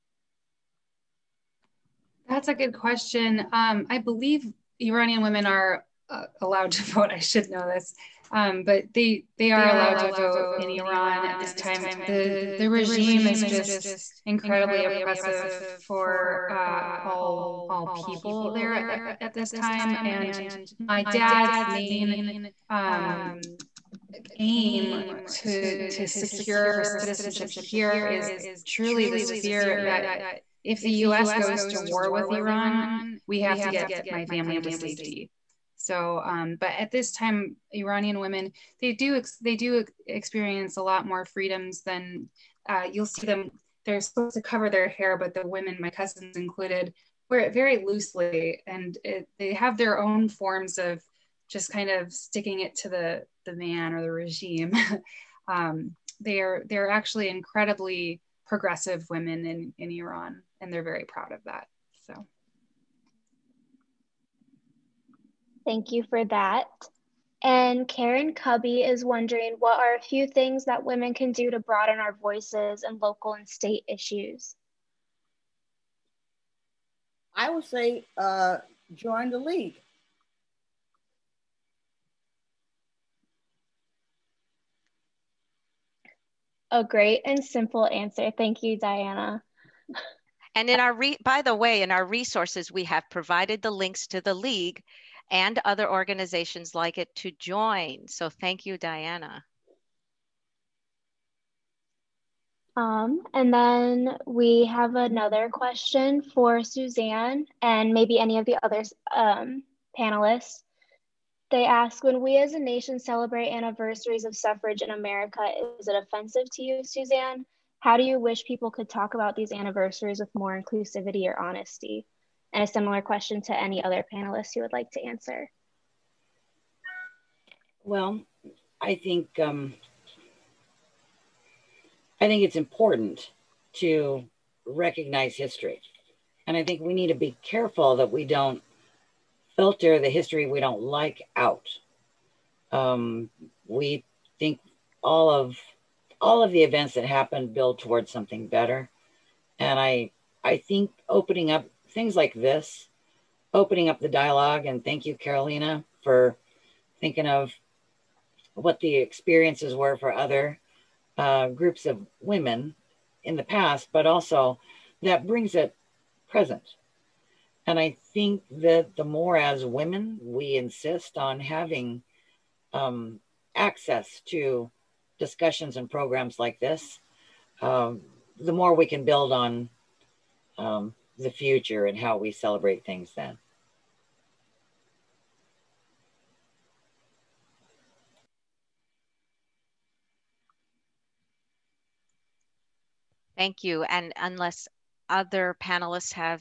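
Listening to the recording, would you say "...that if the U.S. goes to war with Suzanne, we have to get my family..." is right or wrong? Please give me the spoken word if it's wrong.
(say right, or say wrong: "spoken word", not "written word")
wrong: "Iran", not "Suzanne".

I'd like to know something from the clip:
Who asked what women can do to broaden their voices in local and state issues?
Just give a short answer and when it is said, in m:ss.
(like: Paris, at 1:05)
Karen Cubby, at 1:07.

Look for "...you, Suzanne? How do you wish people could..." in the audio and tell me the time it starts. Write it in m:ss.
1:56.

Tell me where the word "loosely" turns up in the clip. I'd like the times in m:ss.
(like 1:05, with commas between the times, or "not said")
0:47.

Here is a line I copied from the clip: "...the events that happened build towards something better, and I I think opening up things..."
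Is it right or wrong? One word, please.
right.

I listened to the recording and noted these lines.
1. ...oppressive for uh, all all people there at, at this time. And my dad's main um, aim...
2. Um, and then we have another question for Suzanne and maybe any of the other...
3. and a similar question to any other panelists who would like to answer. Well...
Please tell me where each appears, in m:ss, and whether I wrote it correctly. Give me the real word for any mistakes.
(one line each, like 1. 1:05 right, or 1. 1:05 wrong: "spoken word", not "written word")
1. 0:14 right
2. 1:42 right
3. 2:02 right.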